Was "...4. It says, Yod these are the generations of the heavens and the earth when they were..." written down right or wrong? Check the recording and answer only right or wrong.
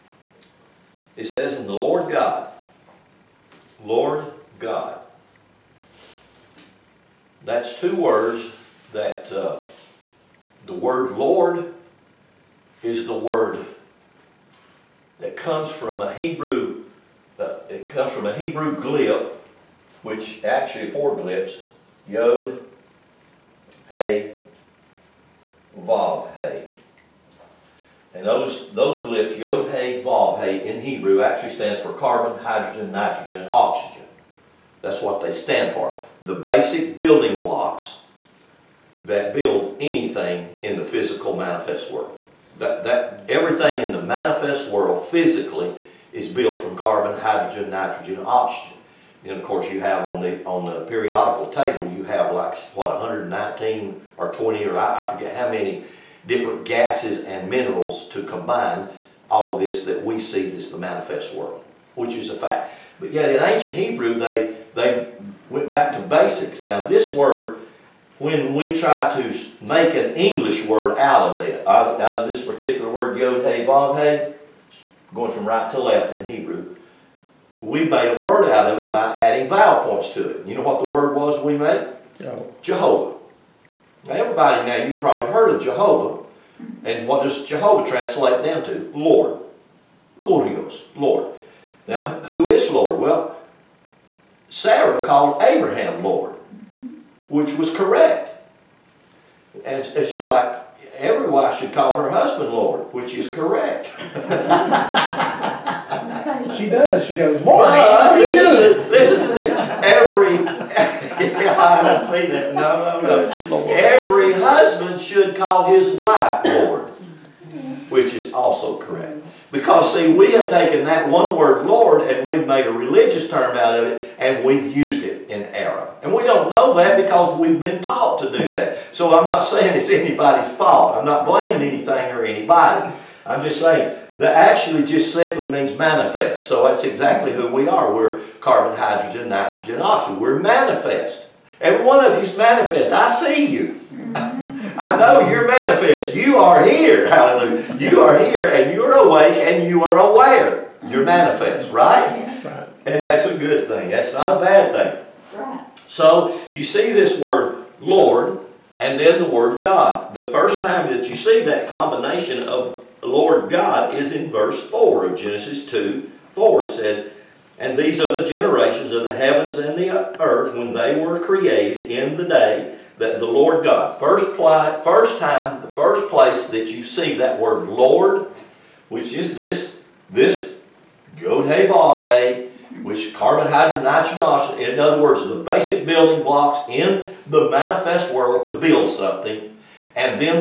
wrong.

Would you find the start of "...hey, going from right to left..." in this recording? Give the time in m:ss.
1:13.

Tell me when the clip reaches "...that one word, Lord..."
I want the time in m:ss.
2:00.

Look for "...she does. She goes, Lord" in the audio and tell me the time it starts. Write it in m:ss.
1:46.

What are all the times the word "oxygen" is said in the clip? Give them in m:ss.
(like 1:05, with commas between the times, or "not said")
0:33, 0:48, 2:19, 3:04.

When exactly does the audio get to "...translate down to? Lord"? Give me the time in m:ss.
1:27.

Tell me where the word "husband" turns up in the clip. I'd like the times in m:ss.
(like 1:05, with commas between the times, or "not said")
1:42, 1:54.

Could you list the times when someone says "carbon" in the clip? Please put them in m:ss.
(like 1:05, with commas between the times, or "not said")
0:31, 0:46, 2:18, 3:03.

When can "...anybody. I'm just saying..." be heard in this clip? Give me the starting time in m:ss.
2:12.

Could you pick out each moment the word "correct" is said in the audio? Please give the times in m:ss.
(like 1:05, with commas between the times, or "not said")
1:37, 1:43, 1:58.